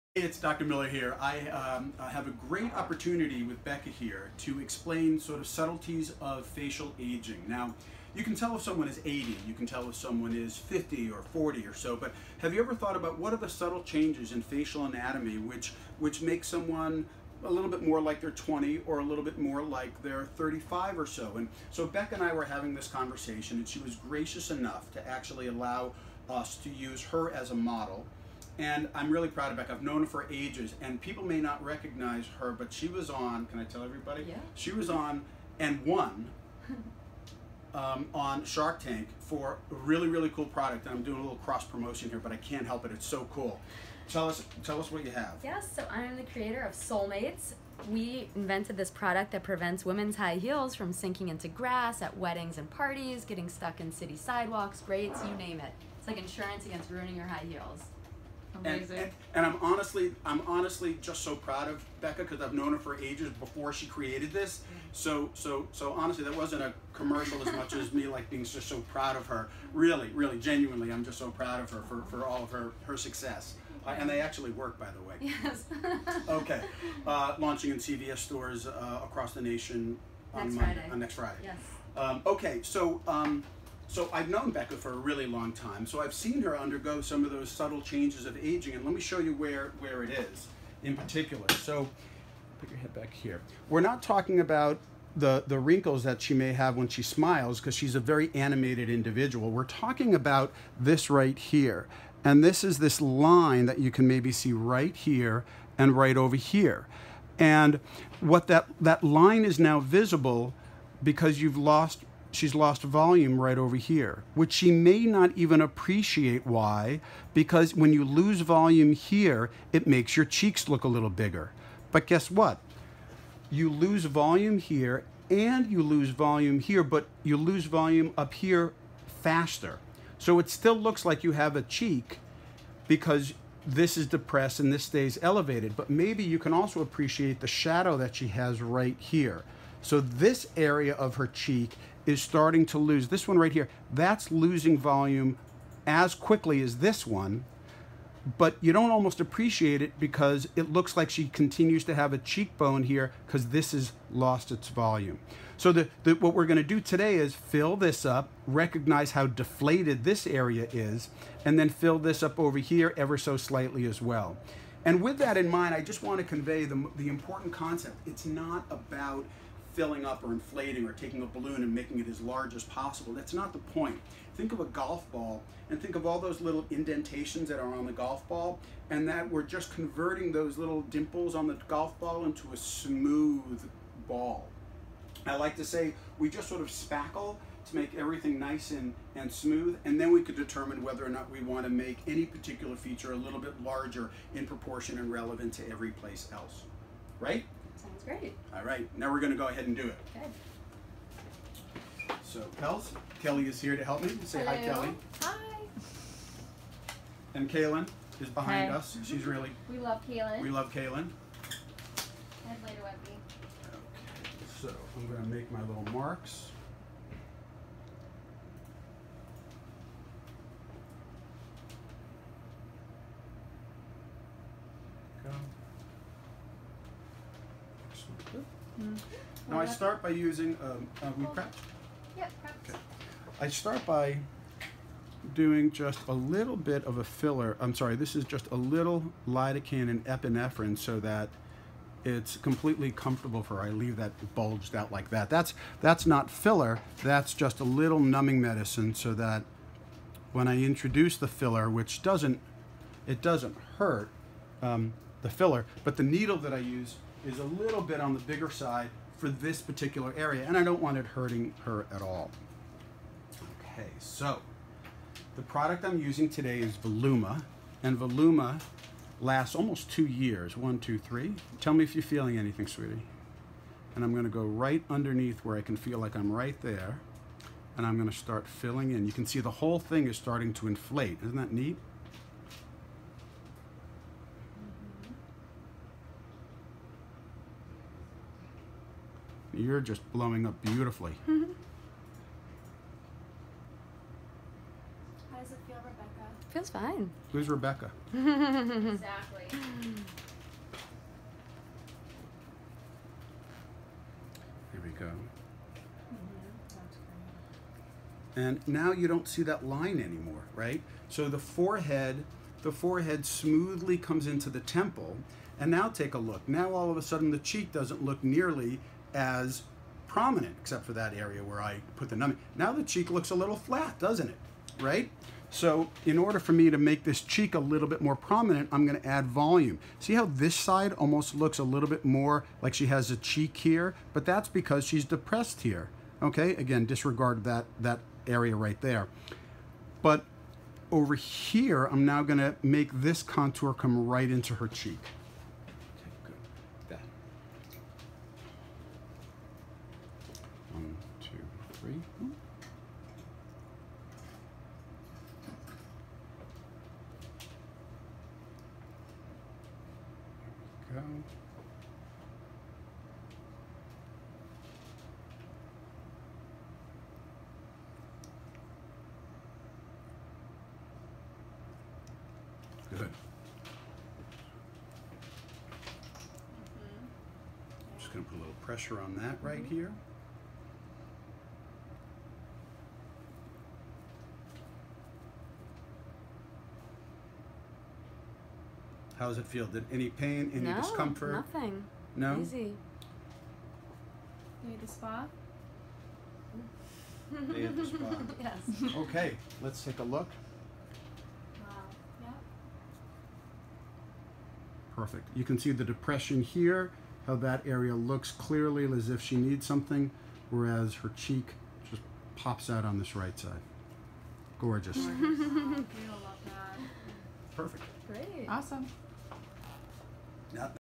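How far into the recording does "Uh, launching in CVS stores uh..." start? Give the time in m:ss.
1:17.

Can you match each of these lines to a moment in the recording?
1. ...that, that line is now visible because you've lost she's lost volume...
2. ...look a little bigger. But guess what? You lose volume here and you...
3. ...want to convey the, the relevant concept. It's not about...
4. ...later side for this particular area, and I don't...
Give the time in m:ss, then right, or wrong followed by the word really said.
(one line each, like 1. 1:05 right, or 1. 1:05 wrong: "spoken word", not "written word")
1. 1:48 right
2. 2:00 right
3. 2:46 wrong: "important", not "relevant"
4. 4:18 wrong: "bigger", not "later".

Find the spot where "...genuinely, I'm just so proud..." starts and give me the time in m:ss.
1:10.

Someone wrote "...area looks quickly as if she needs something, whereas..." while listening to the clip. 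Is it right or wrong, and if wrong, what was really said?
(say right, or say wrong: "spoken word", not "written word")
wrong: "clearly", not "quickly".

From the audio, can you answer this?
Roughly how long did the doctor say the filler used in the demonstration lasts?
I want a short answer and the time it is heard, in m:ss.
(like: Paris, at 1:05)
almost 2 years, at 4:29.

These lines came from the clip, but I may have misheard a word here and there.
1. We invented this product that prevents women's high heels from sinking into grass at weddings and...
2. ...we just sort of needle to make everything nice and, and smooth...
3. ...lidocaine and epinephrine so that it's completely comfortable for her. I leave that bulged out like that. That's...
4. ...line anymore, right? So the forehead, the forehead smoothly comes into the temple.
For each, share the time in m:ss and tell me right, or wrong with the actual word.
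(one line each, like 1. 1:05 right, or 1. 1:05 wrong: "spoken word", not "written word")
1. 0:47 right
2. 3:06 wrong: "spackle", not "needle"
3. 3:59 right
4. 5:09 right.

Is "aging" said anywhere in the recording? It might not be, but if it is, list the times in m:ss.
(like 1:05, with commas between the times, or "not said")
0:06, 1:28.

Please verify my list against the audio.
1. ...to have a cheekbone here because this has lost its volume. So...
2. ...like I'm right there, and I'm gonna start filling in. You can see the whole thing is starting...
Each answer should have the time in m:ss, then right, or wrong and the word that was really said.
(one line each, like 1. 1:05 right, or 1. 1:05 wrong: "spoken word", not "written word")
1. 2:31 right
2. 4:35 right.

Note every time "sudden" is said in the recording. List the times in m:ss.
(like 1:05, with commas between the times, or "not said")
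5:17.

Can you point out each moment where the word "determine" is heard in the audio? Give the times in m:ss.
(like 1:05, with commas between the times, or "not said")
3:10.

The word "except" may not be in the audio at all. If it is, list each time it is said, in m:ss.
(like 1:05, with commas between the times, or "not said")
5:20.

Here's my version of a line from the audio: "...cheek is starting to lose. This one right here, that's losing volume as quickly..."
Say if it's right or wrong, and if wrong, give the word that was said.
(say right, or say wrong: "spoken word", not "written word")
right.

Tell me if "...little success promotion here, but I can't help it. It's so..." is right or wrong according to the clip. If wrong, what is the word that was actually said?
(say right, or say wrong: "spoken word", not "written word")
wrong: "cross", not "success".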